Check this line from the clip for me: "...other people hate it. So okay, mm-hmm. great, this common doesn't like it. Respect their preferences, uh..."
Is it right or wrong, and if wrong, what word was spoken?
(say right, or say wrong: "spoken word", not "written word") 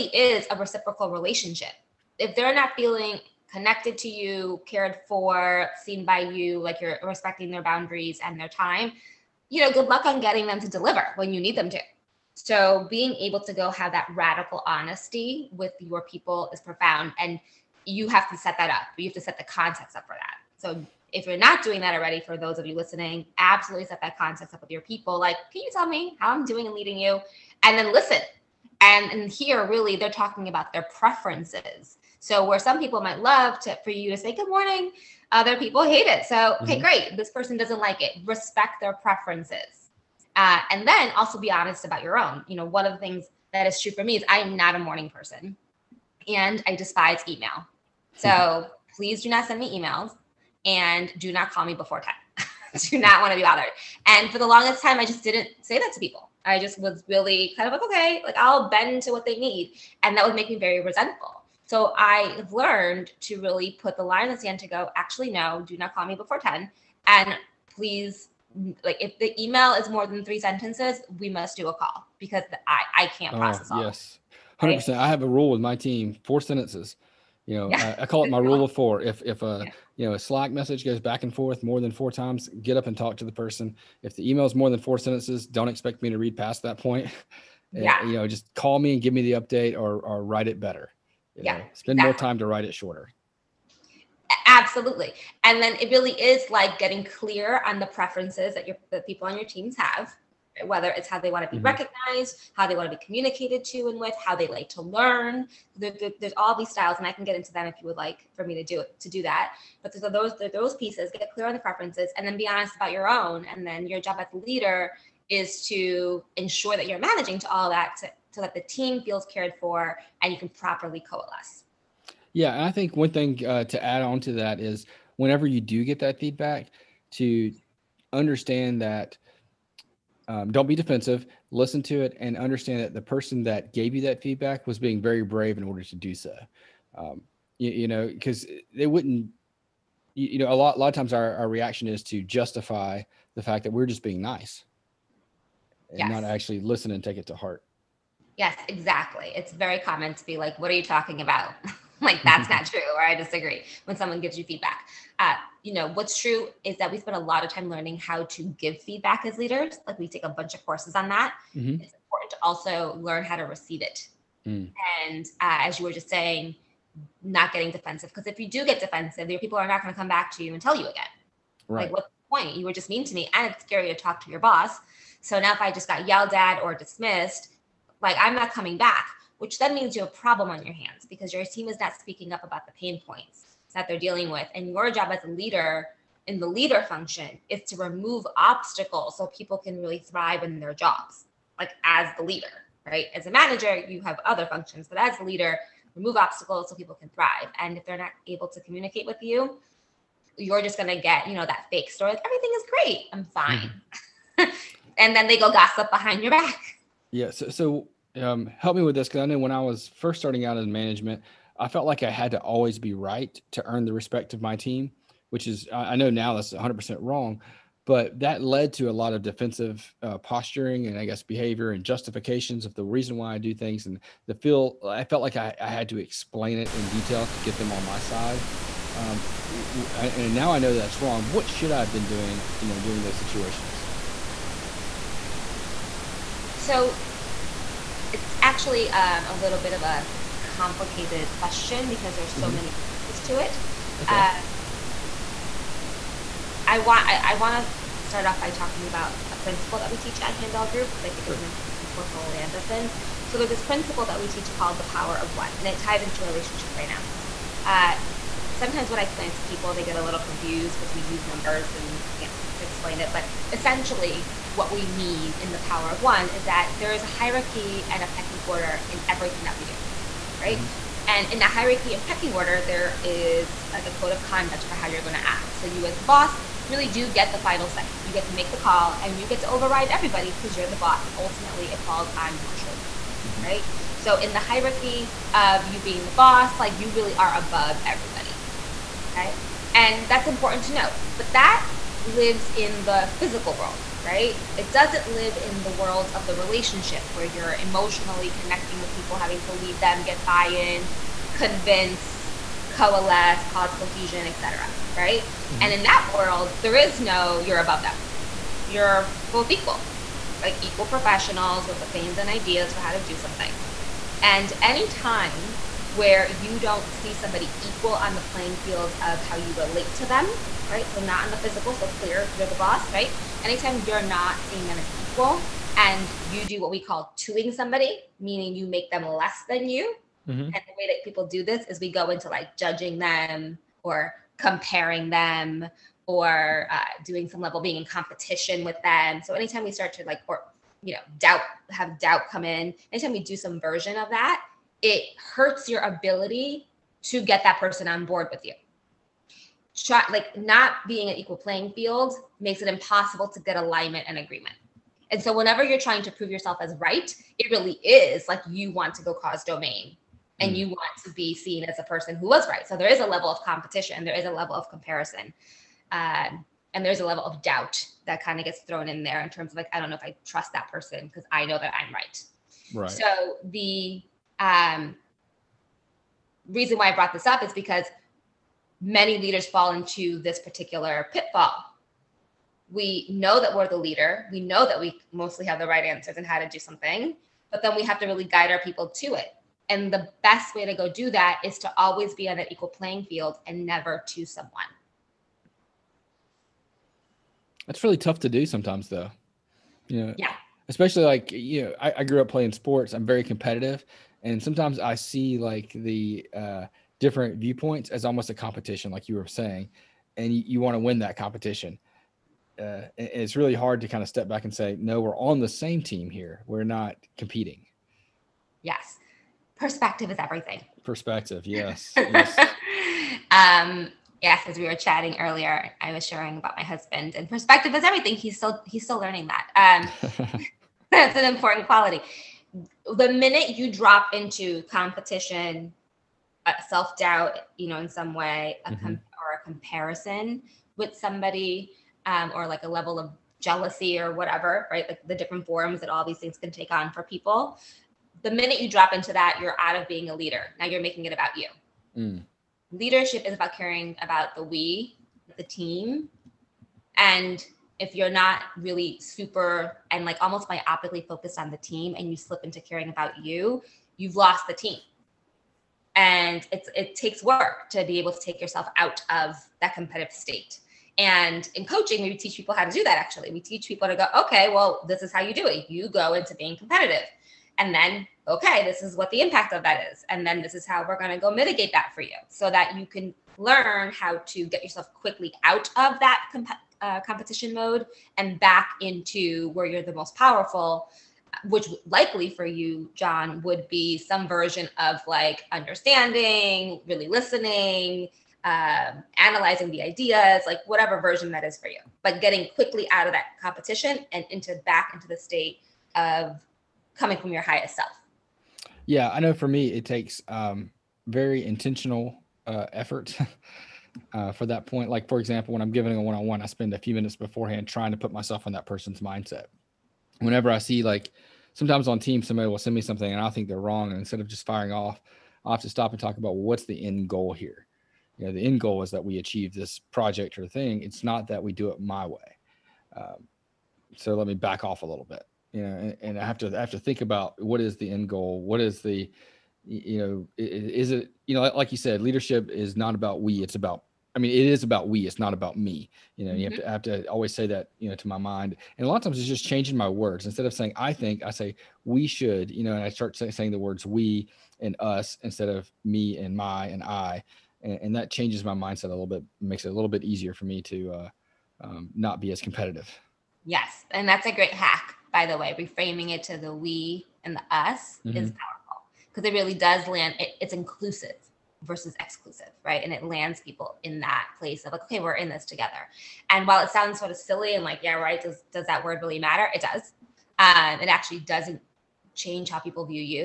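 wrong: "person", not "common".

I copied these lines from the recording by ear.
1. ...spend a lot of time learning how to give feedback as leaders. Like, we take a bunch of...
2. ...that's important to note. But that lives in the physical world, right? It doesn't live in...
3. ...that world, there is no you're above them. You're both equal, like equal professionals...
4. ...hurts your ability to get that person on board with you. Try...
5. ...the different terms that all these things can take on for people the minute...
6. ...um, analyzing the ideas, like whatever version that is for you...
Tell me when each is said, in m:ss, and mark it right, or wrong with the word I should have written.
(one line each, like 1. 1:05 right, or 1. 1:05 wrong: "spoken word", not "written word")
1. 2:36 right
2. 4:50 right
3. 5:05 right
4. 5:45 right
5. 7:25 wrong: "forms", not "terms"
6. 8:18 right.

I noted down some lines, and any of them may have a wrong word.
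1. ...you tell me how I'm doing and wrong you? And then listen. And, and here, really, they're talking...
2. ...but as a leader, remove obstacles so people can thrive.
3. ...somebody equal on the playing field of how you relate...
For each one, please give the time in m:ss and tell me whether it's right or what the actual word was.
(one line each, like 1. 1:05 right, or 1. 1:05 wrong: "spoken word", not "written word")
1. 0:25 wrong: "leading", not "wrong"
2. 3:14 right
3. 5:17 right.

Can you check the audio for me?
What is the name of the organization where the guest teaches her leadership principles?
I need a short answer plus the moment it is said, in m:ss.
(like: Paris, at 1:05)
Handel Group, at 4:10.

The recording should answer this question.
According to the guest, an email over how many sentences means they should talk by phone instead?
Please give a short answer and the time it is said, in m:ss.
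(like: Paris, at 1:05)
3, at 1:10.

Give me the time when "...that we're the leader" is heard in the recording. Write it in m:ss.
6:23.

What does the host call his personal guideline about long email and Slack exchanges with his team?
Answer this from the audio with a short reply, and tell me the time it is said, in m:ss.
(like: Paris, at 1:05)
rule of four, at 1:18.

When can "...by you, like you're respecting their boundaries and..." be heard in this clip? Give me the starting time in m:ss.
0:06.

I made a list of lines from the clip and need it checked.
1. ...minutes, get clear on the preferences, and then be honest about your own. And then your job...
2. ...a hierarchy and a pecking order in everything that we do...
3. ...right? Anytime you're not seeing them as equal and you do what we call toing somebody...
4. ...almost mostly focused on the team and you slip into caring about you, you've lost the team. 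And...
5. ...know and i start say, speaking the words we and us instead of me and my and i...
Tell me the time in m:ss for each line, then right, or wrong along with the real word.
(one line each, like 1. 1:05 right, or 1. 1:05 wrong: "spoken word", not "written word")
1. 1:50 wrong: "pieces", not "minutes"
2. 4:27 right
3. 5:22 right
4. 7:40 wrong: "myopically", not "mostly"
5. 9:12 wrong: "saying", not "speaking".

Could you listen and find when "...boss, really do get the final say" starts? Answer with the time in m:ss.
4:36.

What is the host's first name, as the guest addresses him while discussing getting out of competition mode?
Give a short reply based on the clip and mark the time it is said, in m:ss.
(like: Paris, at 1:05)
John, at 8:12.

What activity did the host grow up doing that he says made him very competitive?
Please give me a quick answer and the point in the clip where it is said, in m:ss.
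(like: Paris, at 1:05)
playing sports, at 6:42.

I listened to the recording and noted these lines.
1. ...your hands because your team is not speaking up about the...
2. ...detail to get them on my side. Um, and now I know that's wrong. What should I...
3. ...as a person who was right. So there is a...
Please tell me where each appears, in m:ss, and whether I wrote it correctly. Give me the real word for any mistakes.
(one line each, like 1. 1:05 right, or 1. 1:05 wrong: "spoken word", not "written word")
1. 3:00 right
2. 3:46 right
3. 6:01 right.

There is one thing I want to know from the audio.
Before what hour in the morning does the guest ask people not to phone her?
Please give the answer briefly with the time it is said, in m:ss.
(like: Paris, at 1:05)
10, at 0:52.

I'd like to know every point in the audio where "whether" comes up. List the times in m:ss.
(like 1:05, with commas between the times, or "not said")
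1:40.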